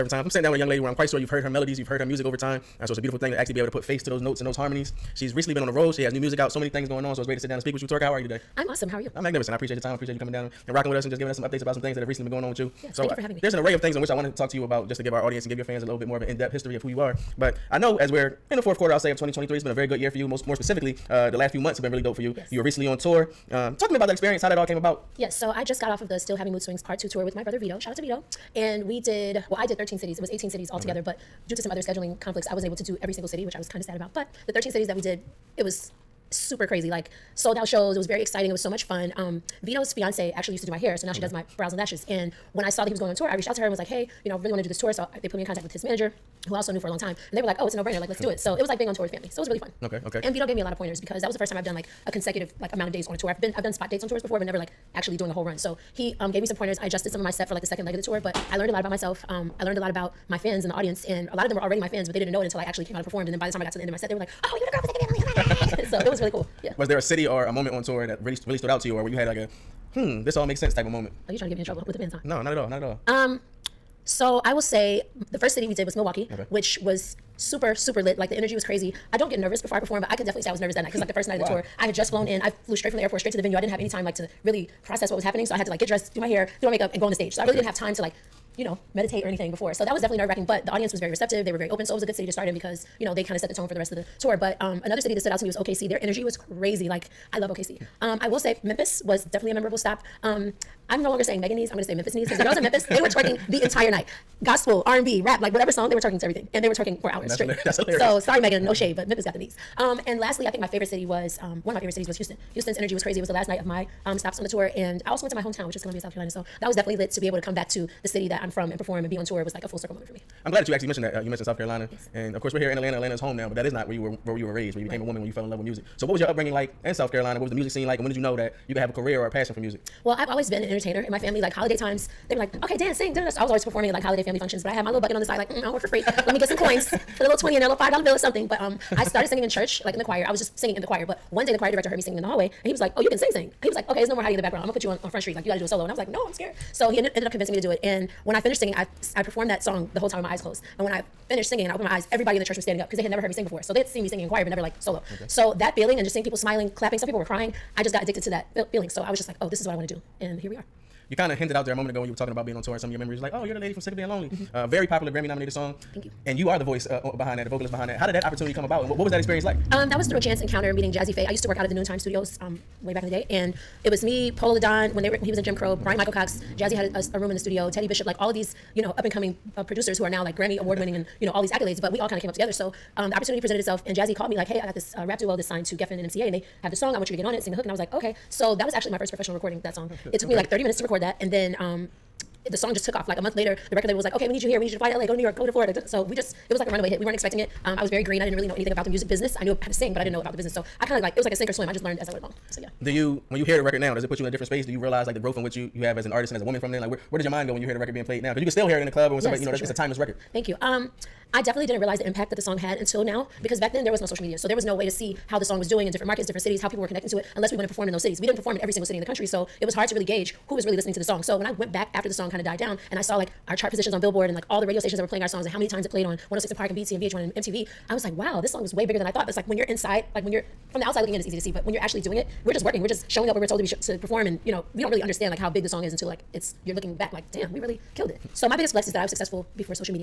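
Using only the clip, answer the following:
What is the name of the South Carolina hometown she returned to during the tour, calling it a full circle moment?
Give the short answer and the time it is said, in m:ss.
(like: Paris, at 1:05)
Columbia, at 1:55.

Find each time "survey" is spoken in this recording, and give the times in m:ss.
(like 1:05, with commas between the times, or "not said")
not said.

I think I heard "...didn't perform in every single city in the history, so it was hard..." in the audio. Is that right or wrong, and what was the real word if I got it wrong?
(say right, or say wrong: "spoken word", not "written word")
wrong: "country", not "history".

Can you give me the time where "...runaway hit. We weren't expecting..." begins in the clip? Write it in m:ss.
3:16.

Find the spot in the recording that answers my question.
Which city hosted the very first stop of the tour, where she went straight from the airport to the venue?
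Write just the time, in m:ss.
1:15.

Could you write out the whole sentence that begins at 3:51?
But when you're actually doing it, we're just working.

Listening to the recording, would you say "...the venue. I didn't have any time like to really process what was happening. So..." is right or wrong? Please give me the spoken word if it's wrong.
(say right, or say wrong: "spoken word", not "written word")
right.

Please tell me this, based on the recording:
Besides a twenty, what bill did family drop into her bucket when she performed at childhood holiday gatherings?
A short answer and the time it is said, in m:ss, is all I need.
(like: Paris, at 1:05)
$5 bill, at 2:17.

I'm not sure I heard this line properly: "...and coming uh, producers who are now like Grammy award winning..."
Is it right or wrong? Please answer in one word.
right.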